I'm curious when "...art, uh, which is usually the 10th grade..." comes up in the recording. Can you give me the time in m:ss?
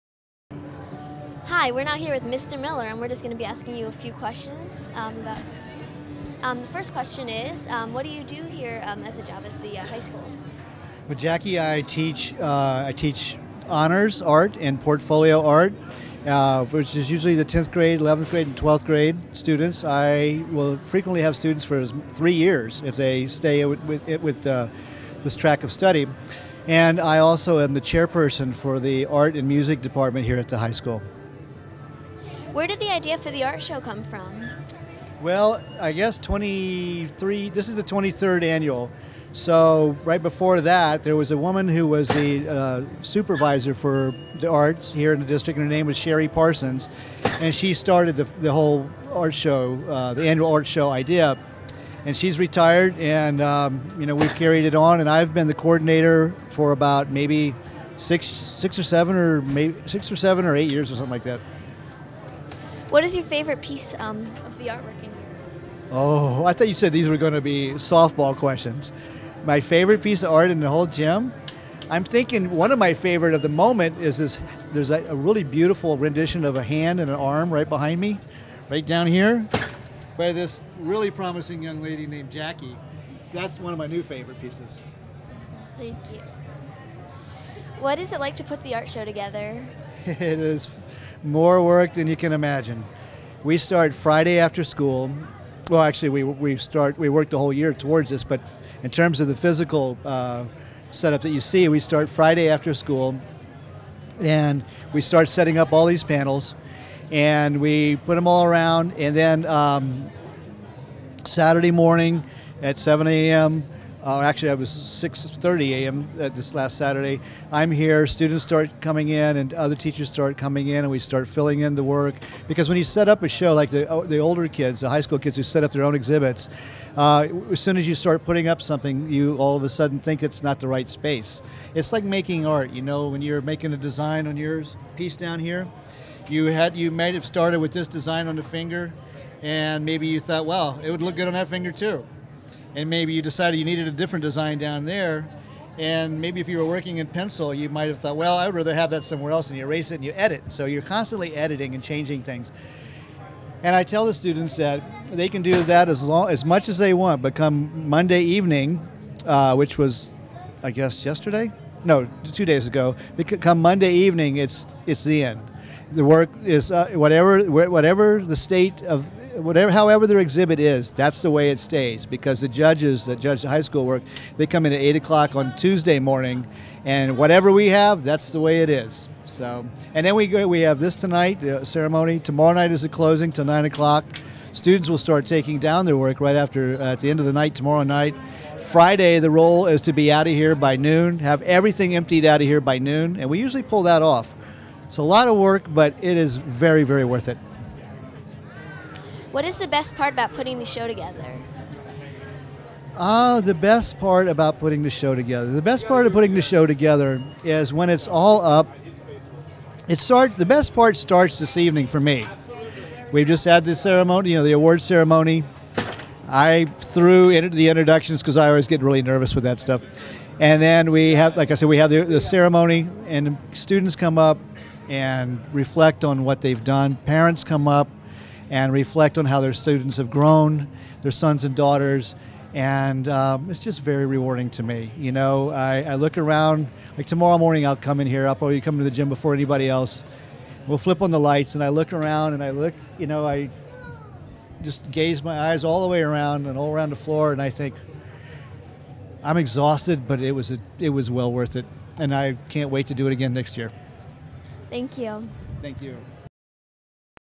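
0:15.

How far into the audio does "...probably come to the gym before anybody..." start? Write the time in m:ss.
3:58.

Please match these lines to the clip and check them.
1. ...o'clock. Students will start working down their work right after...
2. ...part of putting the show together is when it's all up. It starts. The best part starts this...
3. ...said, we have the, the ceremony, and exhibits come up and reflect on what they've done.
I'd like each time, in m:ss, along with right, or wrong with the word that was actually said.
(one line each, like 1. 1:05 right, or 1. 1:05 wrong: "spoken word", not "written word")
1. 3:03 wrong: "taking", not "working"
2. 3:25 right
3. 3:41 wrong: "students", not "exhibits".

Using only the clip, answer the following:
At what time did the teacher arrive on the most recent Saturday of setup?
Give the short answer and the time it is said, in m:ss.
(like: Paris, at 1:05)
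6:30 a.m., at 1:54.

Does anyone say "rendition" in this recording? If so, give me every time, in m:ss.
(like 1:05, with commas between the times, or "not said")
1:15.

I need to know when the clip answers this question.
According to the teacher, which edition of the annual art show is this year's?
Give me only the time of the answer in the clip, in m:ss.
0:37.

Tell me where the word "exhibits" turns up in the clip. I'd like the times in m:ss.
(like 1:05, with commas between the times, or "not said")
2:05, 2:50.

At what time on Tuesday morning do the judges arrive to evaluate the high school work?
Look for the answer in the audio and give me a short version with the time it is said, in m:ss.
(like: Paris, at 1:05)
8 o'clock, at 2:54.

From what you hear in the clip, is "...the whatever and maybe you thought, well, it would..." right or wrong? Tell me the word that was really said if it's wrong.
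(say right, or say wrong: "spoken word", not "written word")
wrong: "finger", not "whatever".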